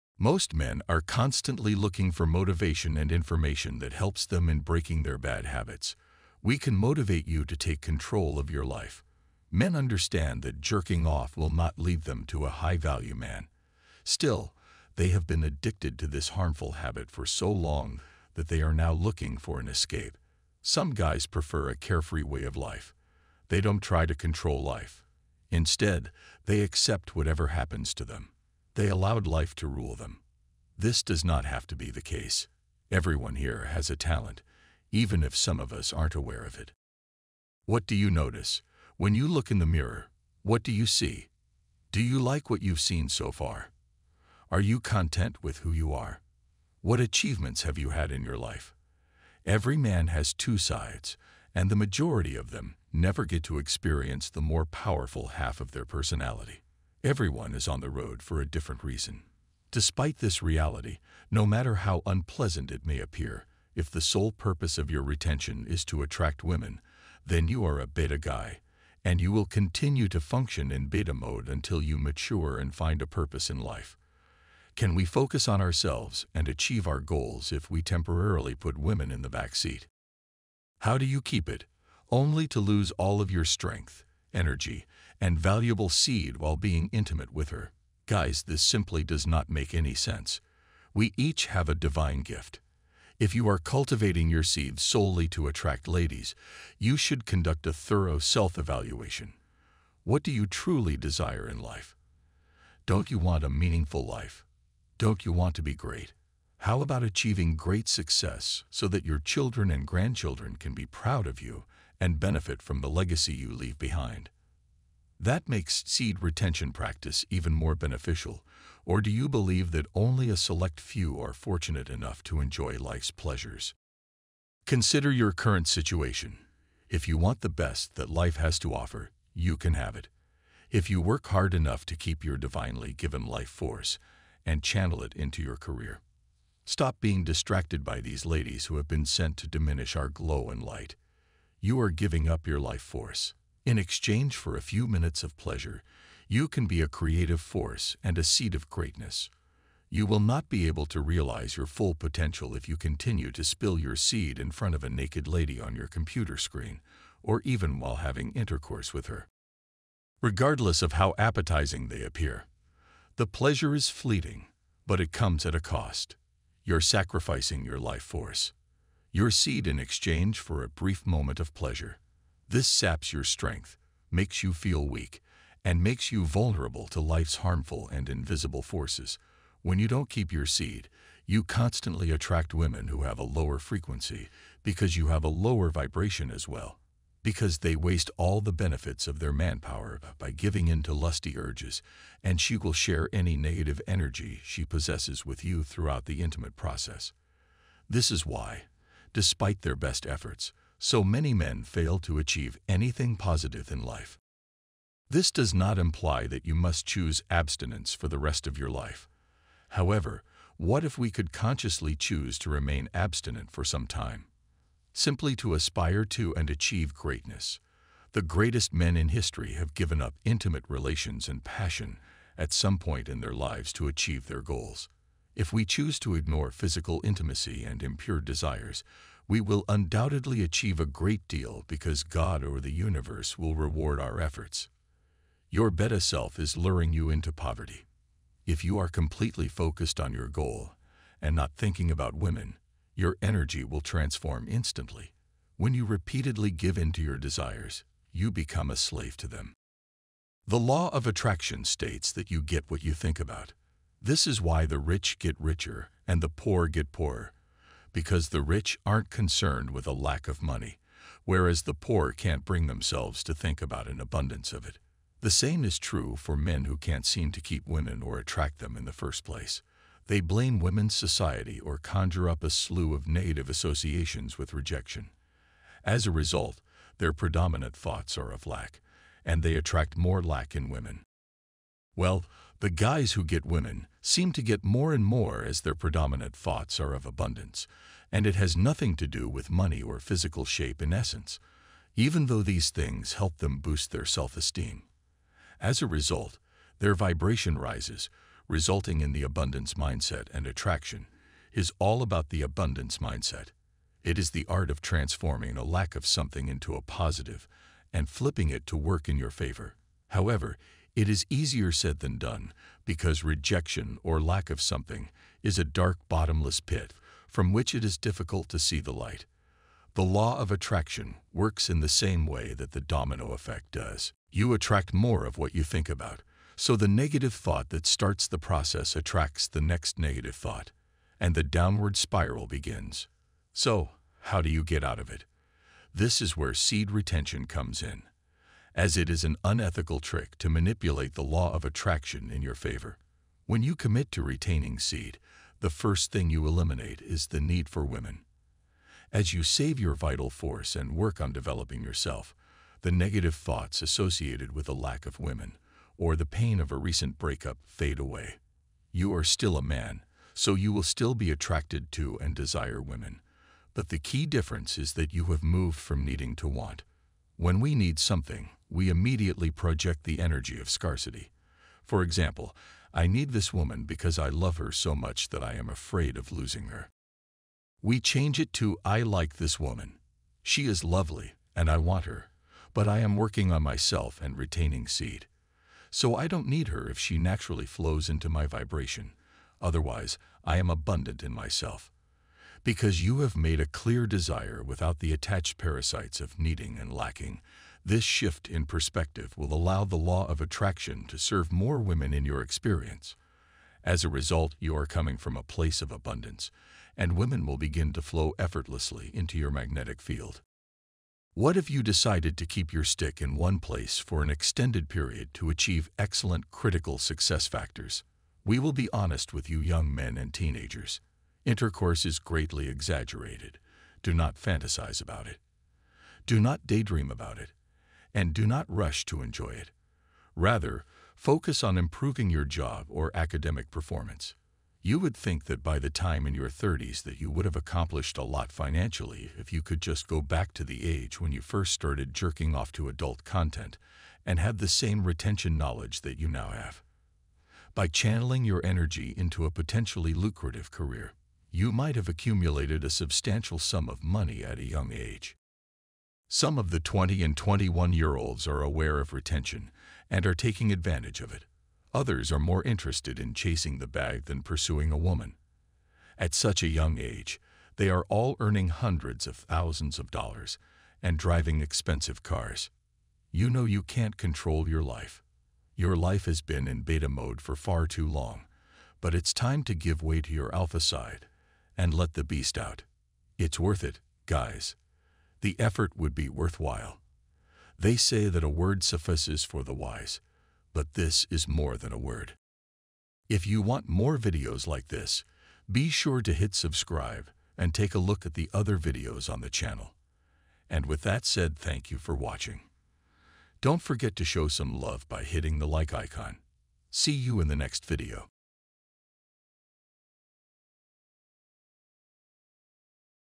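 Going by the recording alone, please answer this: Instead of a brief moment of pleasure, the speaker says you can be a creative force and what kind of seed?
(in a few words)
seed of greatness.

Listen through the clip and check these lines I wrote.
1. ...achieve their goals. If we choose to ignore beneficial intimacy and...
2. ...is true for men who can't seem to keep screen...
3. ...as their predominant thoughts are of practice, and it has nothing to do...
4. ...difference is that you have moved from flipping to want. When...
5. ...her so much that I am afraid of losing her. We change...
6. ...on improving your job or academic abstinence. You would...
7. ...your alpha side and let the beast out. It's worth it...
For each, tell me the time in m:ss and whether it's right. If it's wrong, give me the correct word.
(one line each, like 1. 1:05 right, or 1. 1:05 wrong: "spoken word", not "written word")
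1. 3:43 wrong: "physical", not "beneficial"
2. 4:25 wrong: "women", not "screen"
3. 4:45 wrong: "abundance", not "practice"
4. 6:04 wrong: "needing", not "flipping"
5. 6:14 right
6. 7:11 wrong: "performance", not "abstinence"
7. 8:00 right.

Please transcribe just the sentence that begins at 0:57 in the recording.
Everyone is on the road for a different reason.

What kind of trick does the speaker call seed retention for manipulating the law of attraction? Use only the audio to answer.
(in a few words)
unethical trick.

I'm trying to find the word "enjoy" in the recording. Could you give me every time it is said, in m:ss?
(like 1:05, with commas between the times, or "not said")
2:02, 7:09.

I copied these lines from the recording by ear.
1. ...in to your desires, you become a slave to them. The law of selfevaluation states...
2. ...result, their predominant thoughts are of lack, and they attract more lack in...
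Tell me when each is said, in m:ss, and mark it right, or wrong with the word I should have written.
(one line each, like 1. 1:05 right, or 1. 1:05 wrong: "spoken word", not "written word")
1. 4:06 wrong: "attraction", not "selfevaluation"
2. 4:36 right.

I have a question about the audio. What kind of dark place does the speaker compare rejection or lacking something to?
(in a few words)
bottomless pit.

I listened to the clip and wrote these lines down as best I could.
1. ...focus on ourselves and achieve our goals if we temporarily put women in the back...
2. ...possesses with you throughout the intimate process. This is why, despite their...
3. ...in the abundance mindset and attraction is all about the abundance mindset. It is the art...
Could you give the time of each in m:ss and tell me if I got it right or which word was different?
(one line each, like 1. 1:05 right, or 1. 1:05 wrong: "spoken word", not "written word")
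1. 1:15 right
2. 3:14 right
3. 4:59 right.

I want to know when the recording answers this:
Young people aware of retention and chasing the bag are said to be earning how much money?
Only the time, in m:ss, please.
7:48.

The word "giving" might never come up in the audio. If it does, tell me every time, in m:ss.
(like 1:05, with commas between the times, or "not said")
2:21, 3:10.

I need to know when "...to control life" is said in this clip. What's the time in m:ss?
0:24.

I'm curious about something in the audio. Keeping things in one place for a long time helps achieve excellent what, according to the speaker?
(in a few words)
critical success factors.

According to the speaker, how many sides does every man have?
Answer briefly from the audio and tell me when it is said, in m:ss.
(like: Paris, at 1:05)
2, at 0:50.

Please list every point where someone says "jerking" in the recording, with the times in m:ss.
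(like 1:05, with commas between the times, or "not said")
0:10, 7:22.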